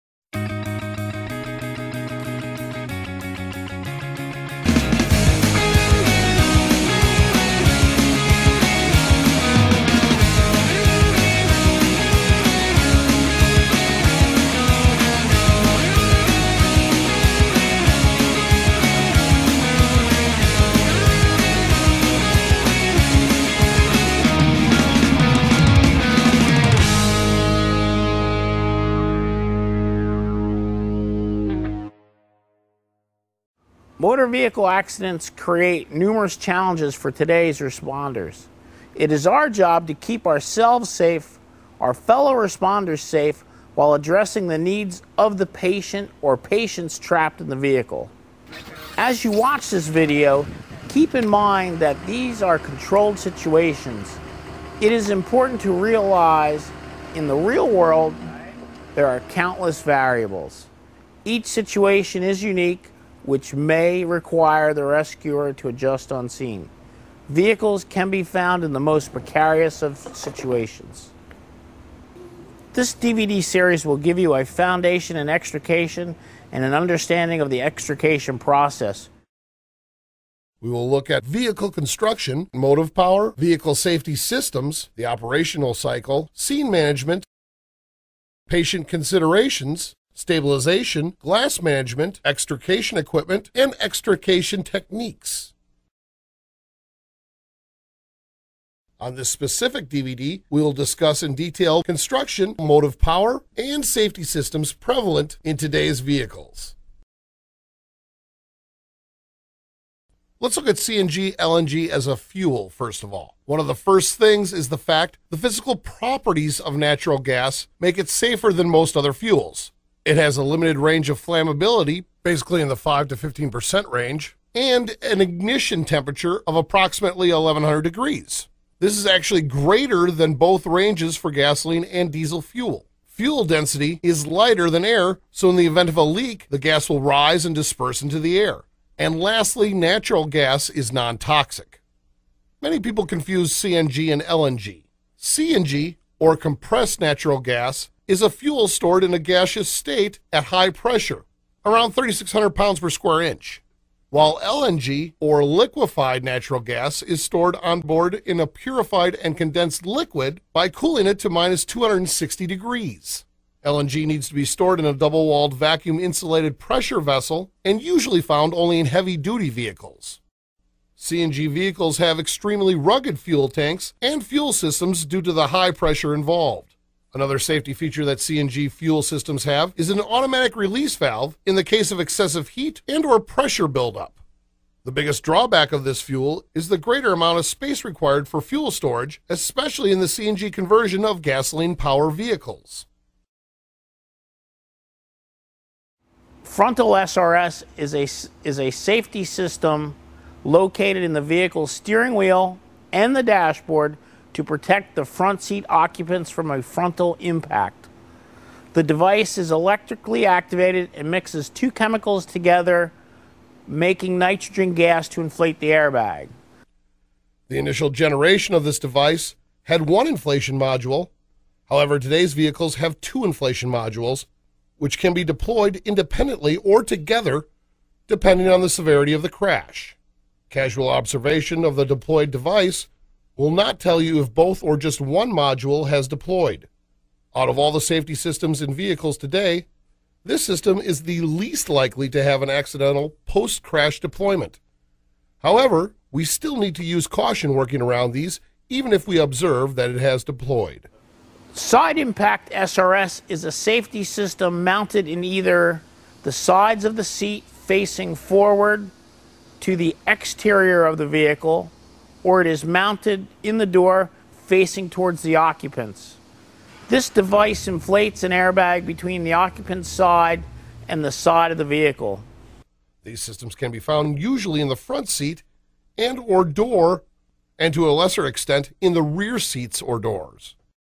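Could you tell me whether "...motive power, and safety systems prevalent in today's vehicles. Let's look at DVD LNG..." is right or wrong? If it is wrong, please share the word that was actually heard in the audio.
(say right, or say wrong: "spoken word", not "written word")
wrong: "CNG", not "DVD".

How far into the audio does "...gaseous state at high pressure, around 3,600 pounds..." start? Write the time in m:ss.
2:29.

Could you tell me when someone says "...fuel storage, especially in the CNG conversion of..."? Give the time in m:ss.
3:08.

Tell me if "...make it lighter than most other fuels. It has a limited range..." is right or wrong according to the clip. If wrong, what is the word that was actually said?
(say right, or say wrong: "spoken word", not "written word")
wrong: "safer", not "lighter".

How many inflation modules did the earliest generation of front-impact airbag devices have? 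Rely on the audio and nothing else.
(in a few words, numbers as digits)
1.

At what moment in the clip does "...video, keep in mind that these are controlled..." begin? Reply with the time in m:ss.
0:49.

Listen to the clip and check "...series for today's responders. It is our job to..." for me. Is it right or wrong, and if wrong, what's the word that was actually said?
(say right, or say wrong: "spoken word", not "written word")
wrong: "challenges", not "series".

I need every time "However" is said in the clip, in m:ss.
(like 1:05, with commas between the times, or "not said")
3:41, 4:05.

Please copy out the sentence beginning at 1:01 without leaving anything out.
Each situation is unique, which may require the rescuer to adjust on scene.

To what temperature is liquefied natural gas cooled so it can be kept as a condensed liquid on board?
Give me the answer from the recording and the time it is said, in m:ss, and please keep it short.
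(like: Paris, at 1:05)
-260 degrees, at 2:41.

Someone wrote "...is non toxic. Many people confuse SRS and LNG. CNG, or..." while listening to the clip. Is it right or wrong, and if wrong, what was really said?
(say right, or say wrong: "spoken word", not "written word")
wrong: "CNG", not "SRS".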